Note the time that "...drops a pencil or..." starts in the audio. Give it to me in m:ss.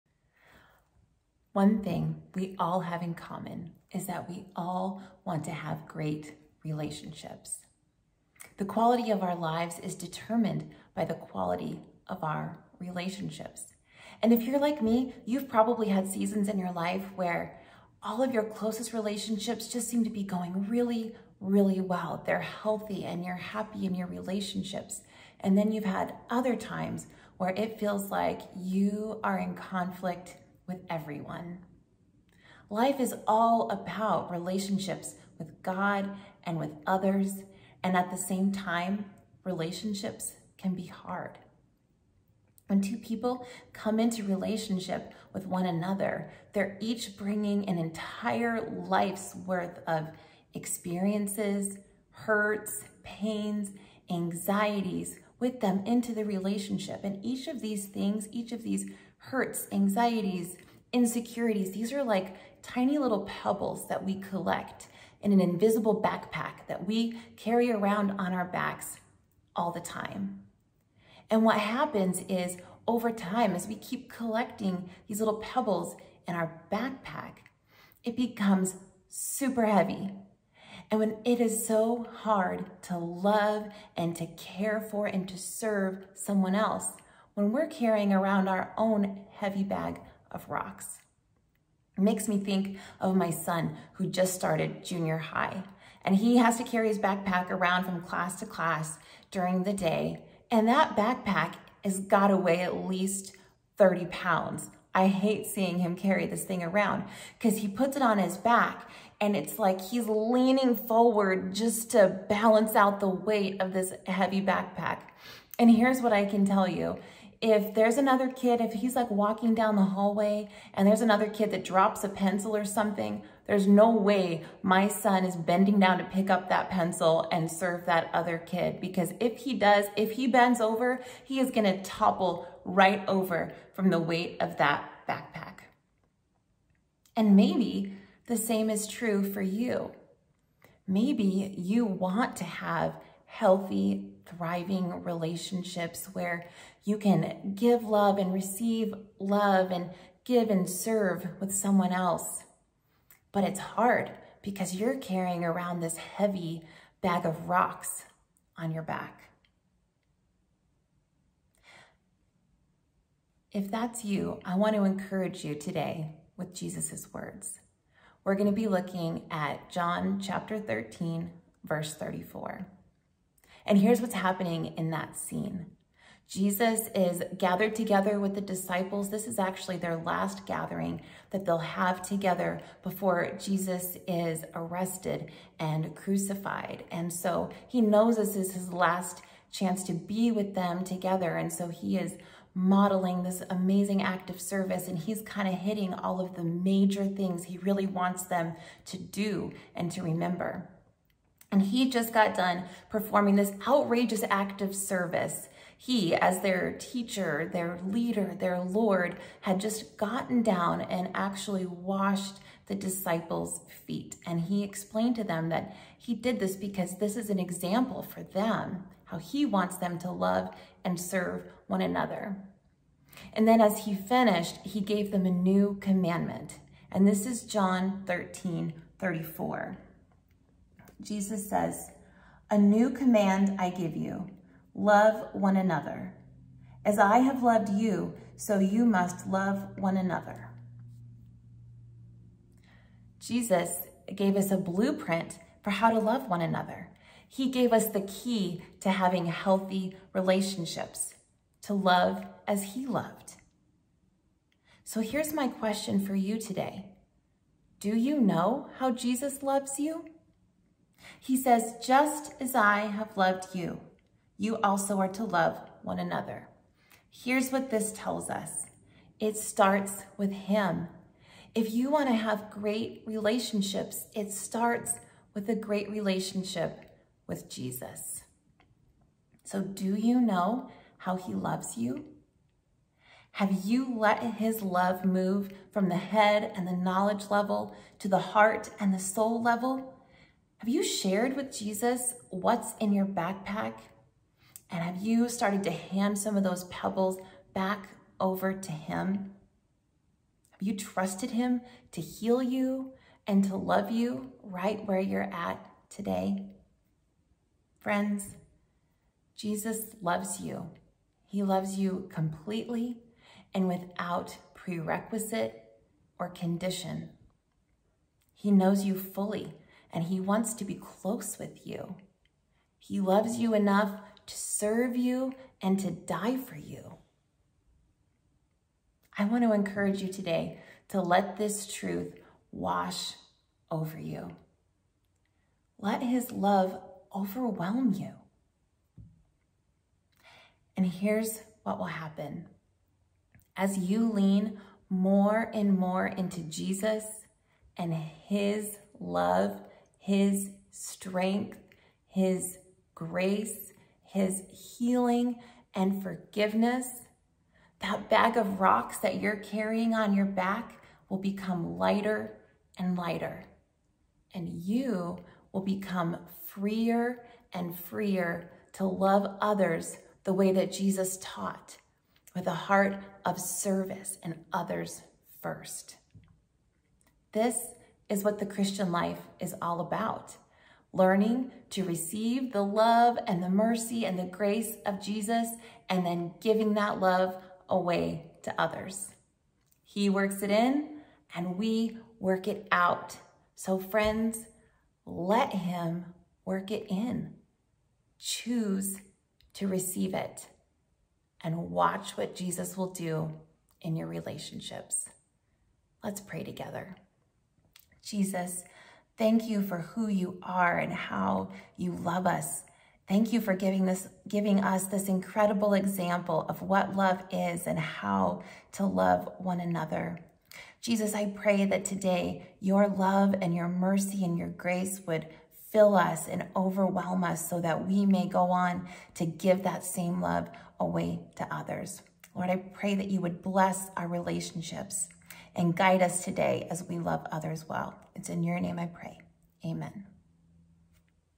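2:01.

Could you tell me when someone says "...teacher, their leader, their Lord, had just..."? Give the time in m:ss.
3:26.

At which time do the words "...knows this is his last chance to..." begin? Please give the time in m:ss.
3:07.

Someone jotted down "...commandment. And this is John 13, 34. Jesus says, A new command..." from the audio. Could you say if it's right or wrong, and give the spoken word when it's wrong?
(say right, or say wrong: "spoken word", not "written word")
right.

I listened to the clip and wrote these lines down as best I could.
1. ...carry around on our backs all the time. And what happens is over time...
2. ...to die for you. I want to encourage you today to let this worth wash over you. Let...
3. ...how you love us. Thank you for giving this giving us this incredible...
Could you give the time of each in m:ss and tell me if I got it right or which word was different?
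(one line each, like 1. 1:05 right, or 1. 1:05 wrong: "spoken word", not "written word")
1. 1:07 right
2. 5:25 wrong: "truth", not "worth"
3. 6:50 right.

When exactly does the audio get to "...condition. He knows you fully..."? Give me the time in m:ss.
5:16.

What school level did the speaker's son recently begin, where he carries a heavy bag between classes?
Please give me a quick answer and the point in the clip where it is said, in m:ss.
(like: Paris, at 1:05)
Junior high, at 1:34.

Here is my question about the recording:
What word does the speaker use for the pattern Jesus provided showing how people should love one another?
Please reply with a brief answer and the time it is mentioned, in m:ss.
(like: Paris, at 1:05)
Blueprint, at 4:04.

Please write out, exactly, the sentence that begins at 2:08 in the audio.
Because if he does, if he bends over, he is gonna topple right over from the weight of that backpack.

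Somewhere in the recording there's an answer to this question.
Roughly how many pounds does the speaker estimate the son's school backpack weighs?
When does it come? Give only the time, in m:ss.
1:43.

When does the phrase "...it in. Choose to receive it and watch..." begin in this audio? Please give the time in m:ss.
6:36.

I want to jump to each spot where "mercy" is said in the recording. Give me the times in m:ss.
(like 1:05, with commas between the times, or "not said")
6:23, 7:03.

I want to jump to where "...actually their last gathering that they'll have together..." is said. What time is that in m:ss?
2:59.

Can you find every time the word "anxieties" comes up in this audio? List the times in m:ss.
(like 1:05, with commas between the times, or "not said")
0:54, 0:59.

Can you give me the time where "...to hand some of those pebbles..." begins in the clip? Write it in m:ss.
4:55.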